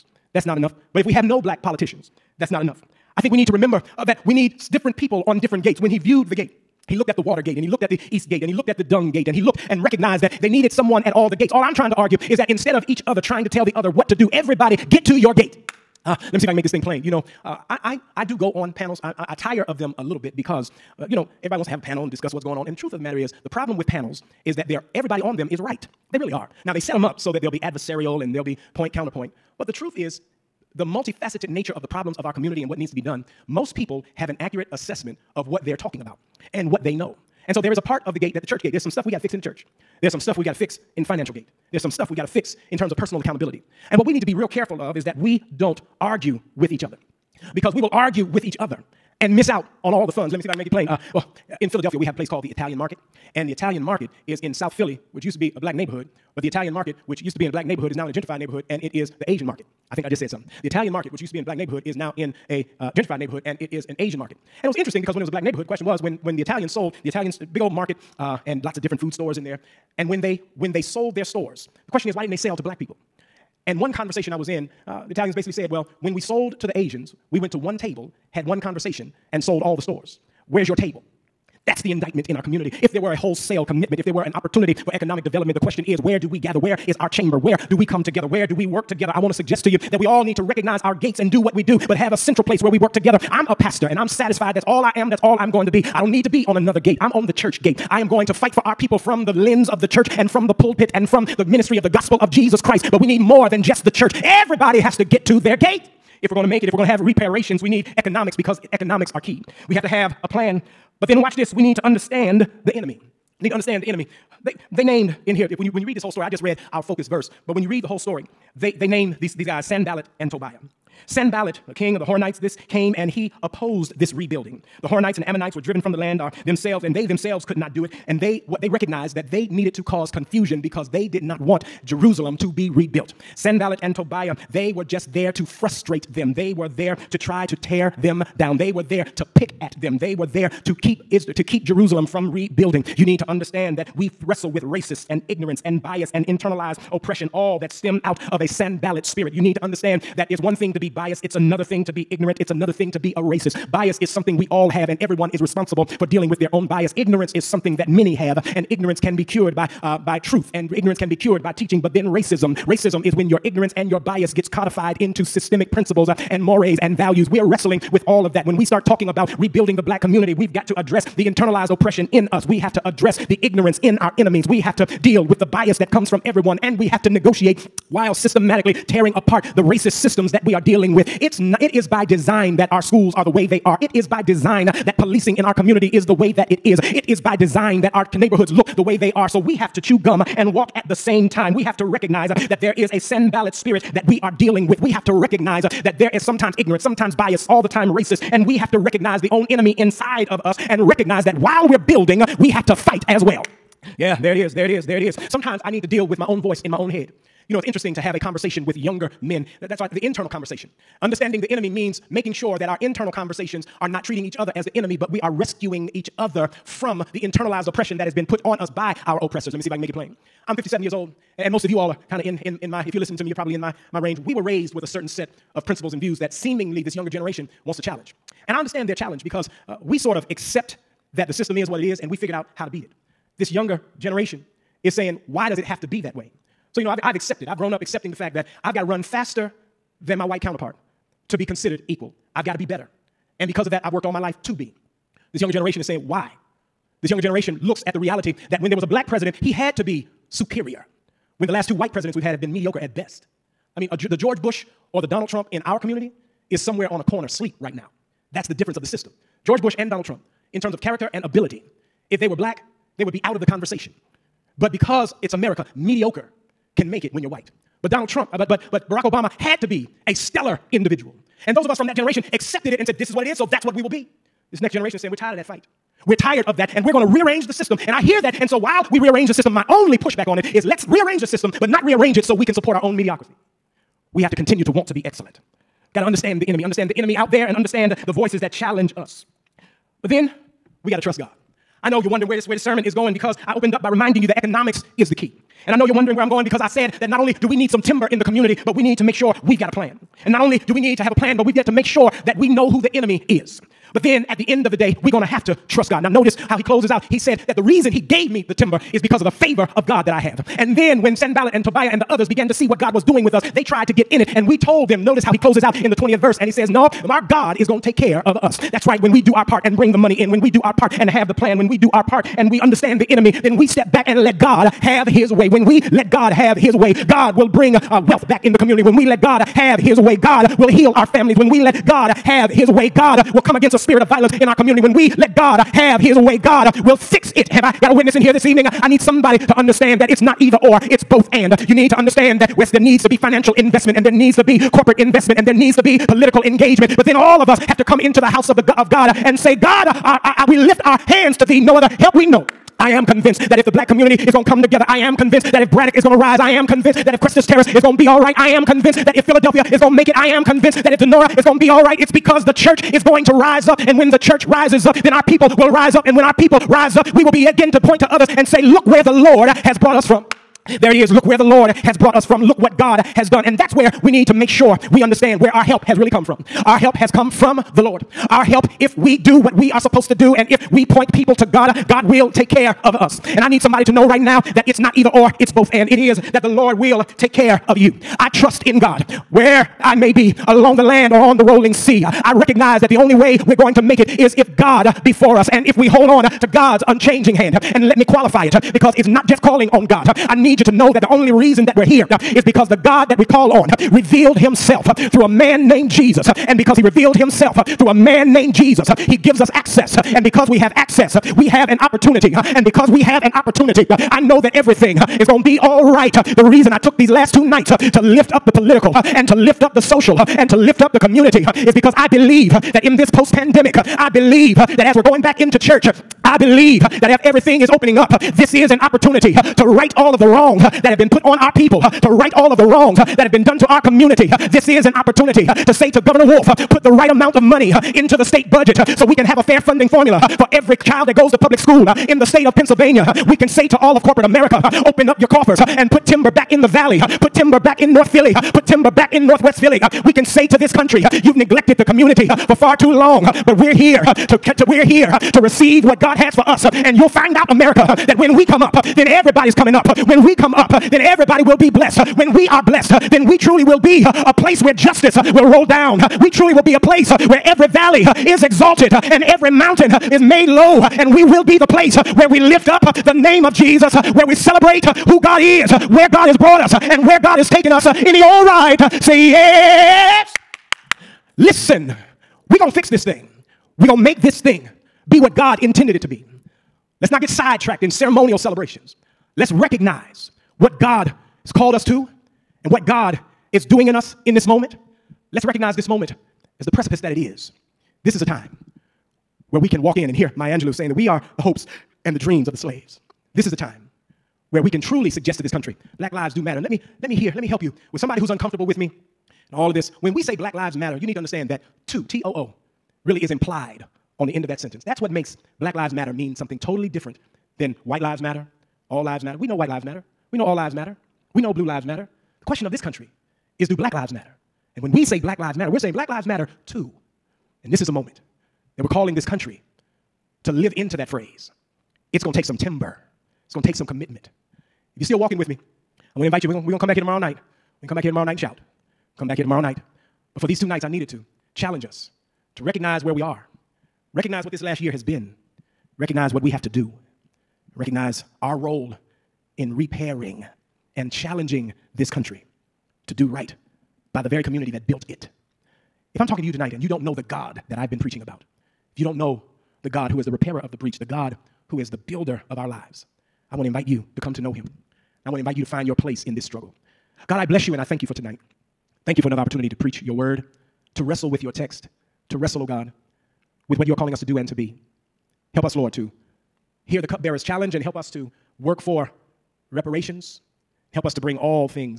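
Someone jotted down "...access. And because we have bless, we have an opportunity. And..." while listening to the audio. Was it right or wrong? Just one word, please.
wrong.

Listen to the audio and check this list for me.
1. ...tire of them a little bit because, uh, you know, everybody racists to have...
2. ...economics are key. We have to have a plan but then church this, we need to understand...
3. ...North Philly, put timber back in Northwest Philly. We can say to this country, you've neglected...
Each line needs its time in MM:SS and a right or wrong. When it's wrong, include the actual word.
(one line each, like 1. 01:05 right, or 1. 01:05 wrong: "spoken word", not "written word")
1. 00:19 wrong: "wants", not "racists"
2. 01:48 wrong: "watch", not "church"
3. 07:27 right.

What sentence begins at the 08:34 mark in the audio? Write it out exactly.
That's what makes Black Lives Matter means something totally different than White Lives Matter, All Lives Matter.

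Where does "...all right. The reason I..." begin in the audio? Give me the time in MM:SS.
06:55.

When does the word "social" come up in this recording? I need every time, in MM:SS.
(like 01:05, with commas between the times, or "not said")
06:59.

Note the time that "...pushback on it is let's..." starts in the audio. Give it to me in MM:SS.
04:39.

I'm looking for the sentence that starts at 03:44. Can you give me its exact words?
We were raised with a certain set of principles and views that seemingly this younger generation wants to challenge.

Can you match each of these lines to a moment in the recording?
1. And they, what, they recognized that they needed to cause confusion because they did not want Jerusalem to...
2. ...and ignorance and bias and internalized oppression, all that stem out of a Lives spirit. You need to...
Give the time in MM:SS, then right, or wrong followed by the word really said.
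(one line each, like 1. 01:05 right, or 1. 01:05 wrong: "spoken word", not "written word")
1. 02:08 right
2. 02:25 wrong: "Sanballat", not "Lives".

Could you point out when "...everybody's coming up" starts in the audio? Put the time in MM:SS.
07:39.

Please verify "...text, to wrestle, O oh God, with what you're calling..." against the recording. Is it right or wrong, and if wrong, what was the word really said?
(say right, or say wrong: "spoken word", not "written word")
right.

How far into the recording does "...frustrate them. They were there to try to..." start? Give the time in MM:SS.
02:15.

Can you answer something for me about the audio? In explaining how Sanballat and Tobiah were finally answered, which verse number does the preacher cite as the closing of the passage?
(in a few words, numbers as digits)
20th verse.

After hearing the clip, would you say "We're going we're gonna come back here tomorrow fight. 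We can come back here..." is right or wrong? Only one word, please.
wrong.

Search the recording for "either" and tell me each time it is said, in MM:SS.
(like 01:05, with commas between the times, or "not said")
05:40, 06:24.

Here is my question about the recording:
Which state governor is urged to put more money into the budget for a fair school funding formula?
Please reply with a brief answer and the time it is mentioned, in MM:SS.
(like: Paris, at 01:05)
Governor Wolf, at 07:15.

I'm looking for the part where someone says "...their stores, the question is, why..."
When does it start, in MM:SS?
01:11.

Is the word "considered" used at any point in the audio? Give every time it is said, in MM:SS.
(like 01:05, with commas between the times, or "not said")
04:01.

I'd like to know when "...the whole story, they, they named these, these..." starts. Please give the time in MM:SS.
01:57.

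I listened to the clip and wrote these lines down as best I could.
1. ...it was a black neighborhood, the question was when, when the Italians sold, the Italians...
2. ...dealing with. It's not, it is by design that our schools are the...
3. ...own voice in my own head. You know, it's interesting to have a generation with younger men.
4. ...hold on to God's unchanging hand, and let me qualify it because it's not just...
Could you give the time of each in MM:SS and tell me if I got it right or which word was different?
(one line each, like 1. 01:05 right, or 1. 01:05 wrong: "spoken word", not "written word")
1. 01:05 right
2. 03:00 right
3. 03:26 wrong: "conversation", not "generation"
4. 06:35 right.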